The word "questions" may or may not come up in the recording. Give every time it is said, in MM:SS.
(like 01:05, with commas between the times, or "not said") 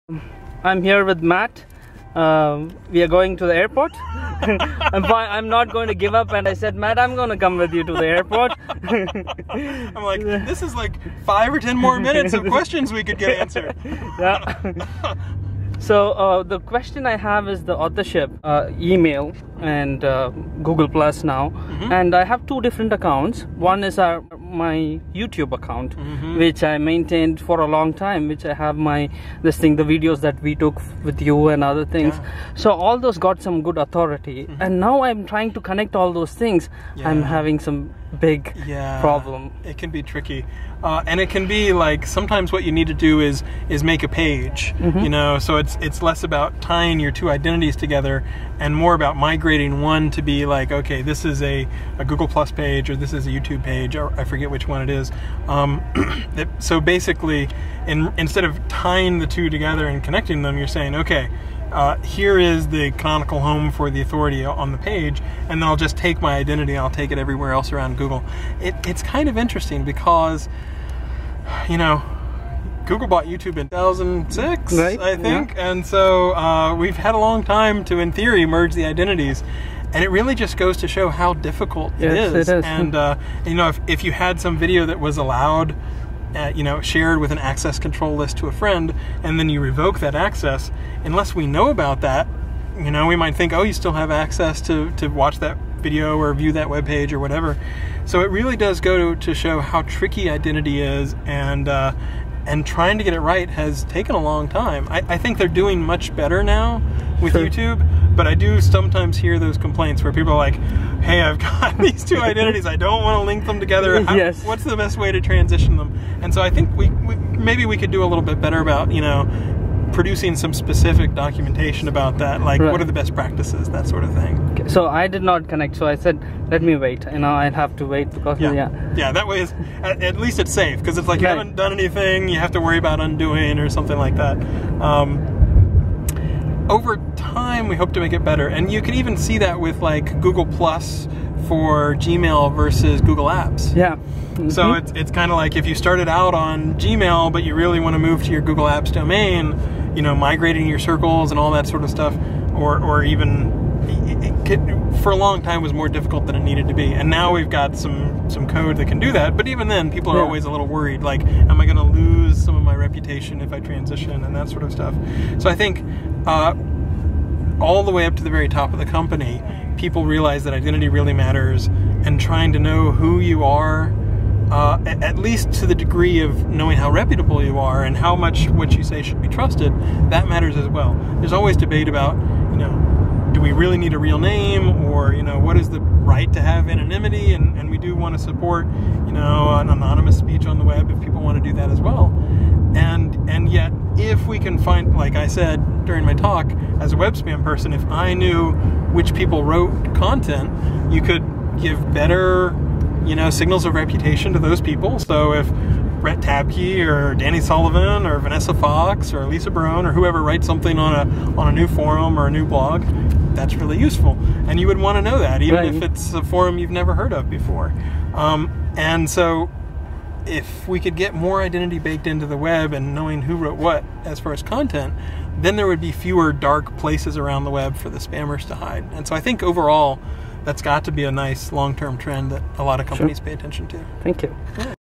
00:12, 00:16.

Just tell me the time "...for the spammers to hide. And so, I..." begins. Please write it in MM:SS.
03:47.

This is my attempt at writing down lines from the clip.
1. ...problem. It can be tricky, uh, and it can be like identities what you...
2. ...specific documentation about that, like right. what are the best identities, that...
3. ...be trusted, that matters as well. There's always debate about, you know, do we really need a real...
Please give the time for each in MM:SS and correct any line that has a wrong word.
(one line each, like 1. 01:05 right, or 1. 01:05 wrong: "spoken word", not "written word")
1. 00:39 wrong: "sometimes", not "identities"
2. 02:00 wrong: "practices", not "identities"
3. 02:59 right.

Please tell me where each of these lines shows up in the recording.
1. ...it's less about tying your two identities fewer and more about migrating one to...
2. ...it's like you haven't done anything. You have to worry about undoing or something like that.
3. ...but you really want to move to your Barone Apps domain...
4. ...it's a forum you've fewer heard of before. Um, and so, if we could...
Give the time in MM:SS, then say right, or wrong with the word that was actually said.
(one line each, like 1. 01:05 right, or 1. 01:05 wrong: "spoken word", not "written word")
1. 00:45 wrong: "together", not "fewer"
2. 02:10 right
3. 02:27 wrong: "Google", not "Barone"
4. 03:35 wrong: "never", not "fewer".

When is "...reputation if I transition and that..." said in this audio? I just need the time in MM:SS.
02:42.